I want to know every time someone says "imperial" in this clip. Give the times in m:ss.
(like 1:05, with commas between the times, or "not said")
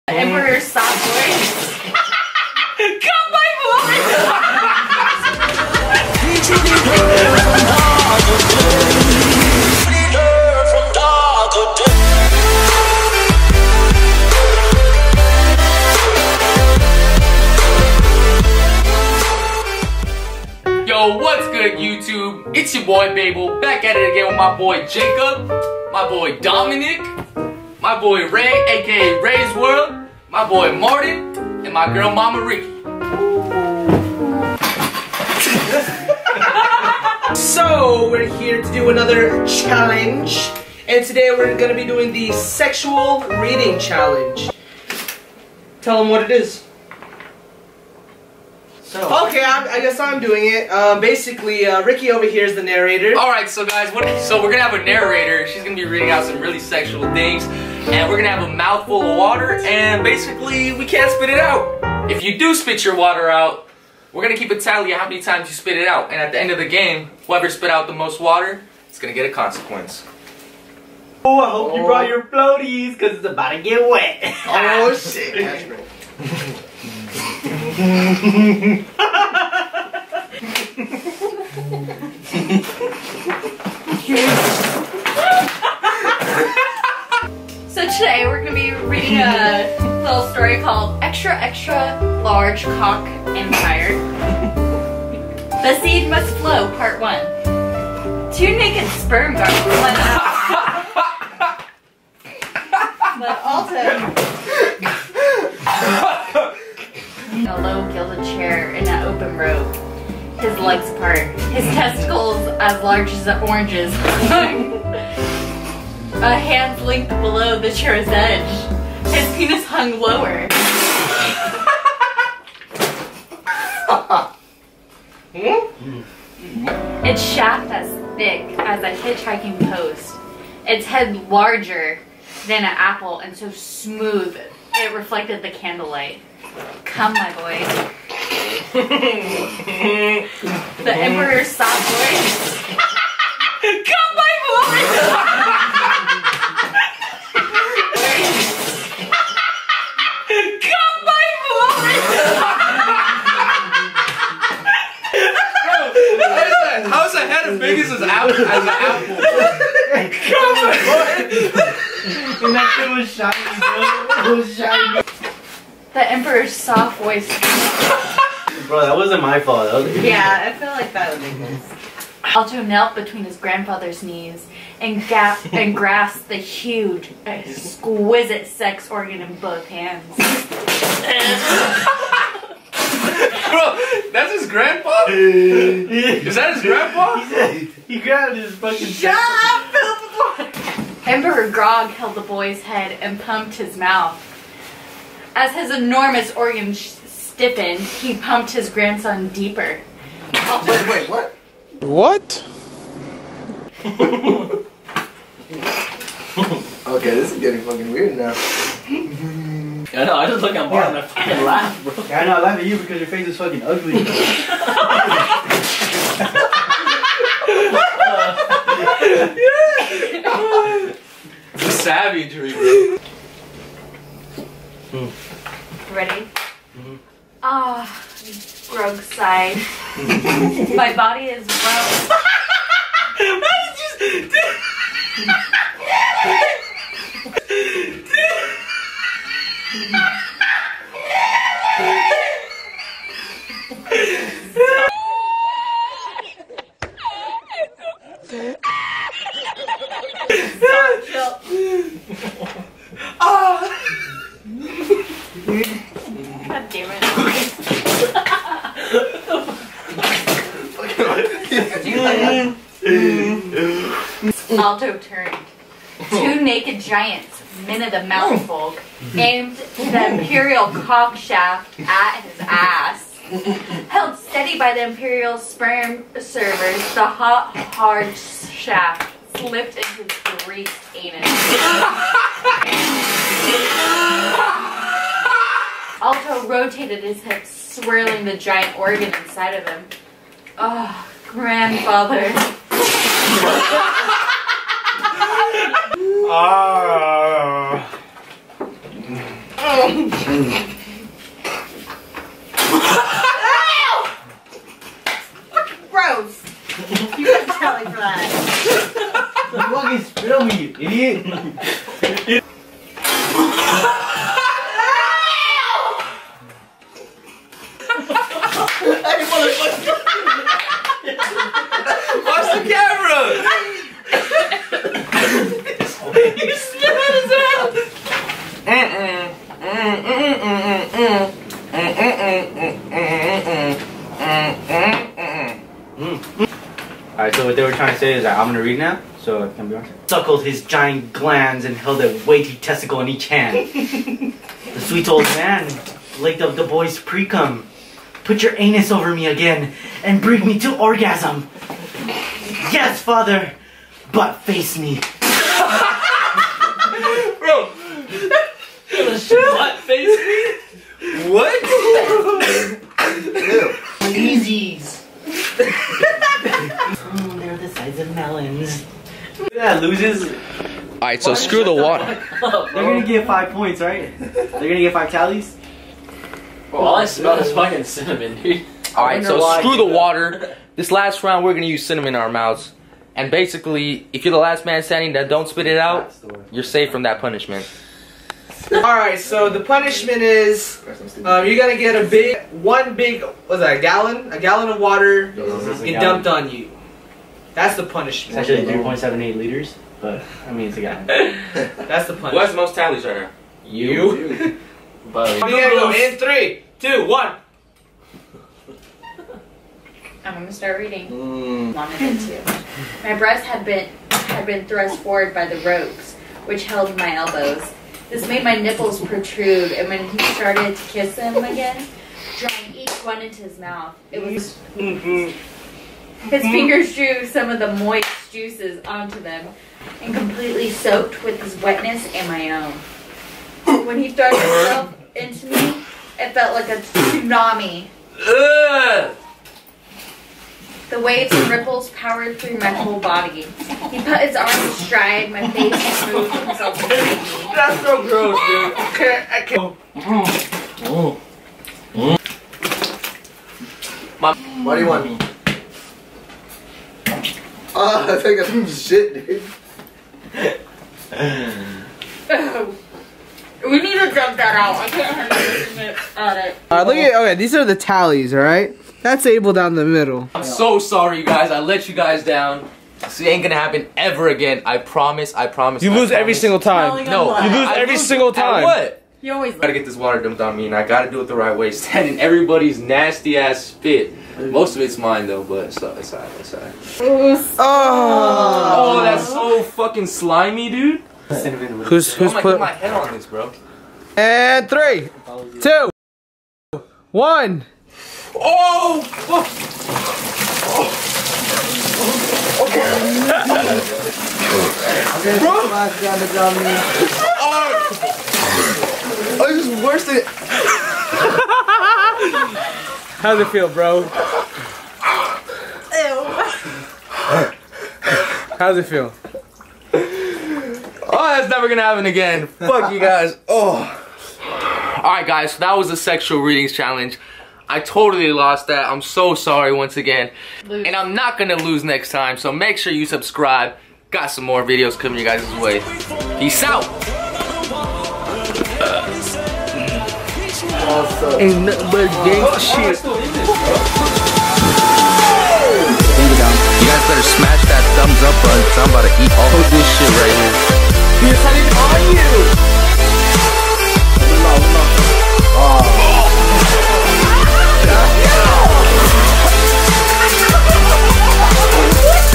4:30, 4:34.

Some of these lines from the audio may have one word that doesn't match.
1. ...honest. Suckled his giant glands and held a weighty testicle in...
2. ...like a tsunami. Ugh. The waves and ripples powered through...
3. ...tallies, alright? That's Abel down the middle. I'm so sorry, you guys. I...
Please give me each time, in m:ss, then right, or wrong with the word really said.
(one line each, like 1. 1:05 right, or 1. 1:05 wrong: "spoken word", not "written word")
1. 5:39 right
2. 7:16 right
3. 7:47 right.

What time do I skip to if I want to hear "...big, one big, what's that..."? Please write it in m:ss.
6:32.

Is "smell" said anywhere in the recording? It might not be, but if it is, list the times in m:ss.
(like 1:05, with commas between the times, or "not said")
6:17.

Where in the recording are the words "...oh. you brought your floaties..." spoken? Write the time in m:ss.
1:11.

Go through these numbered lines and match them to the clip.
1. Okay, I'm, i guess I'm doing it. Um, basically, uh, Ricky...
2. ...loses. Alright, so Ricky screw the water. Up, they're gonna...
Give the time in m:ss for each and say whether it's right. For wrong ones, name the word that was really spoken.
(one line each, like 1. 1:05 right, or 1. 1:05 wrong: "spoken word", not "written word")
1. 0:49 right
2. 6:09 wrong: "Why", not "Ricky".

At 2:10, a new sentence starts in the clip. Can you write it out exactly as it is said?
Its head larger than an apple and so smooth it reflected the candlelight.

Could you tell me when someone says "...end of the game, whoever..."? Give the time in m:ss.
1:06.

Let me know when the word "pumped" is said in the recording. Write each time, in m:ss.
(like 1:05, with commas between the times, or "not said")
3:13, 3:18.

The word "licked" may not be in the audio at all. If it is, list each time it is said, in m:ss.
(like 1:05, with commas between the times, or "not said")
5:46.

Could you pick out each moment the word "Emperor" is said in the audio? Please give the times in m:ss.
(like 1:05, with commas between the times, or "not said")
2:20, 2:46, 3:11.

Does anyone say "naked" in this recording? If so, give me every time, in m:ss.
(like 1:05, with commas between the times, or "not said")
1:38, 4:26.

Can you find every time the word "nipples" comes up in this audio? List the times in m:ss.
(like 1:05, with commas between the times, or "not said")
6:58.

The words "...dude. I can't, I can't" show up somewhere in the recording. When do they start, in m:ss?
7:28.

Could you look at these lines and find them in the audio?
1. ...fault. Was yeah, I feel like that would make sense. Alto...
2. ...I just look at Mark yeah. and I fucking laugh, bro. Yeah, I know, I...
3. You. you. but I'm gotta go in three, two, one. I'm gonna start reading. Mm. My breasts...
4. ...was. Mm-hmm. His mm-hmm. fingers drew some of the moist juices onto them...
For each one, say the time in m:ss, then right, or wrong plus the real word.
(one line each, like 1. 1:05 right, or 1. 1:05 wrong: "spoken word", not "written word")
1. 2:49 right
2. 3:30 right
3. 6:43 right
4. 7:04 right.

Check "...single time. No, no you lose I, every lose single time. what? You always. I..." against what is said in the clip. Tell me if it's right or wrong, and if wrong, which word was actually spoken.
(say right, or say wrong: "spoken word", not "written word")
right.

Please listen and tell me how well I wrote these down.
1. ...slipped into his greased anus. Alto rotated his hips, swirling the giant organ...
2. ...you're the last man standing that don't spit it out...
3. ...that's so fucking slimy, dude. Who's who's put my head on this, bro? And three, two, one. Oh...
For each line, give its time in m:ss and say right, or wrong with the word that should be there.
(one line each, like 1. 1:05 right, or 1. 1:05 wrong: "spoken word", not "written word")
1. 4:39 right
2. 6:24 right
3. 8:09 right.